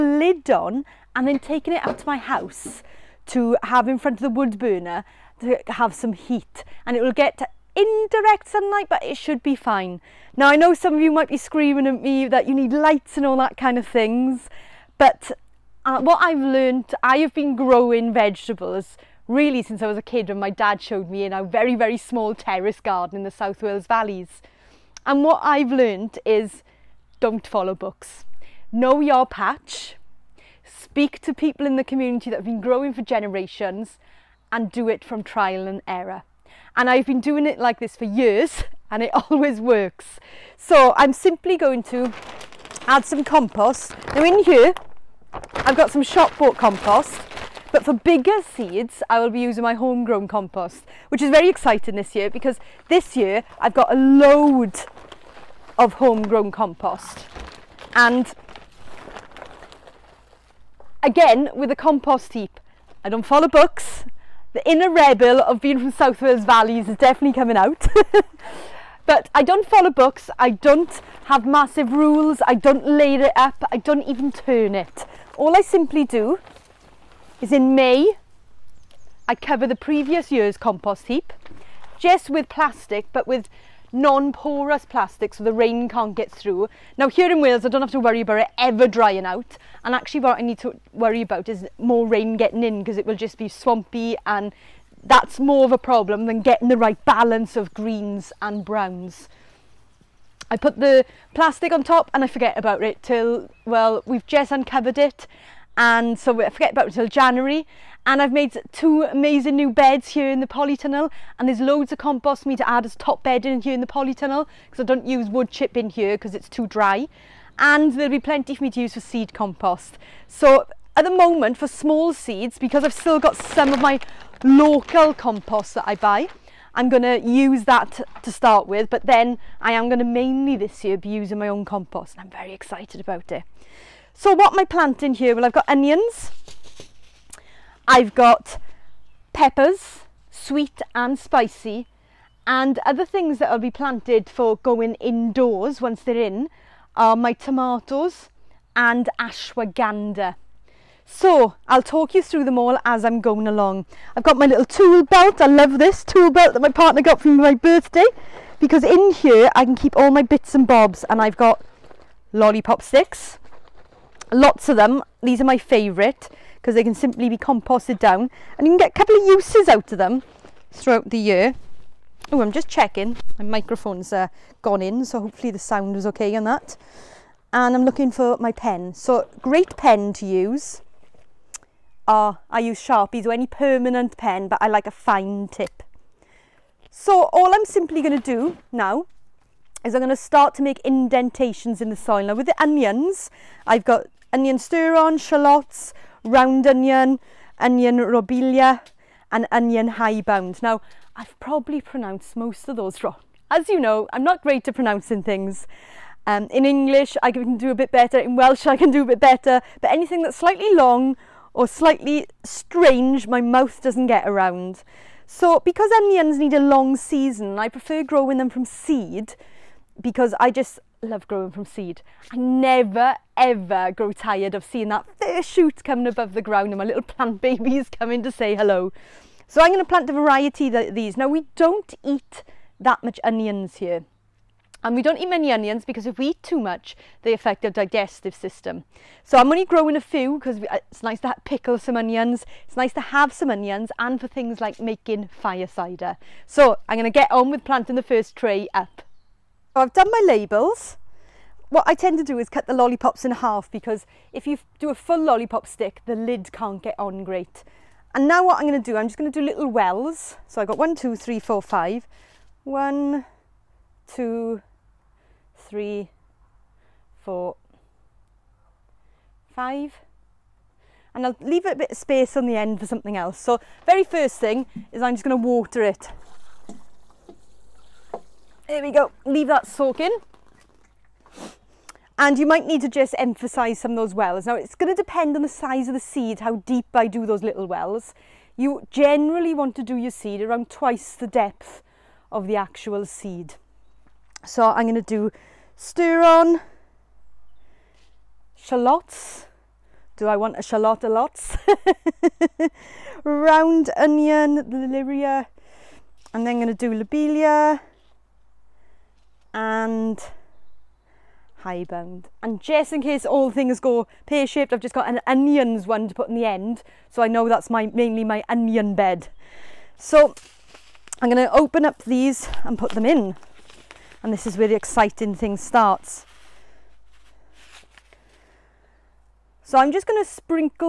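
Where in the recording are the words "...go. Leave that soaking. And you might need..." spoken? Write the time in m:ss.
4:38.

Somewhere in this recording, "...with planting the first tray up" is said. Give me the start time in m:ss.
4:07.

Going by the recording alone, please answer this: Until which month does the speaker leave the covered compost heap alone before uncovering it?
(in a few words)
January.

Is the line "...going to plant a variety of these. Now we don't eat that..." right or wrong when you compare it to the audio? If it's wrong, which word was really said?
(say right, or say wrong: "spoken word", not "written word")
right.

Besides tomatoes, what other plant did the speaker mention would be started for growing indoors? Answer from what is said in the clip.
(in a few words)
Ashwagandha.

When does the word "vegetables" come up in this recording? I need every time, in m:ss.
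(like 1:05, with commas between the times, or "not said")
0:18.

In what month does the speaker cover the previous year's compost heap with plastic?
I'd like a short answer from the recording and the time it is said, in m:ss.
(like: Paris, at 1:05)
May, at 1:17.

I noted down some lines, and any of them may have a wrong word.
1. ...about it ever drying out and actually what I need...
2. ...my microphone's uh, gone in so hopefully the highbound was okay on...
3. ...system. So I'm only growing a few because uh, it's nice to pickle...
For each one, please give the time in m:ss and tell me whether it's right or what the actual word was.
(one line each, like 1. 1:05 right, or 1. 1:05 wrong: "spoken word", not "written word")
1. 1:28 right
2. 2:53 wrong: "sound", not "highbound"
3. 3:58 right.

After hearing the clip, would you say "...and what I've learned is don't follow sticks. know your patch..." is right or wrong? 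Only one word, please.
wrong.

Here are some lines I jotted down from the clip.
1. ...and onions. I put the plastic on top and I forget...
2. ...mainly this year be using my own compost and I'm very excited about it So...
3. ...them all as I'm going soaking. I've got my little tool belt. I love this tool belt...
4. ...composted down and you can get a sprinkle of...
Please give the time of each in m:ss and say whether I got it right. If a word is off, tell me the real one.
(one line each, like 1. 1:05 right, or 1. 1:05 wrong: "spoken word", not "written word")
1. 1:38 wrong: "browns", not "onions"
2. 2:10 right
3. 2:32 wrong: "along", not "soaking"
4. 2:47 wrong: "couple", not "sprinkle".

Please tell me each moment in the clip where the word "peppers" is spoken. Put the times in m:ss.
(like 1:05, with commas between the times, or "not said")
2:19.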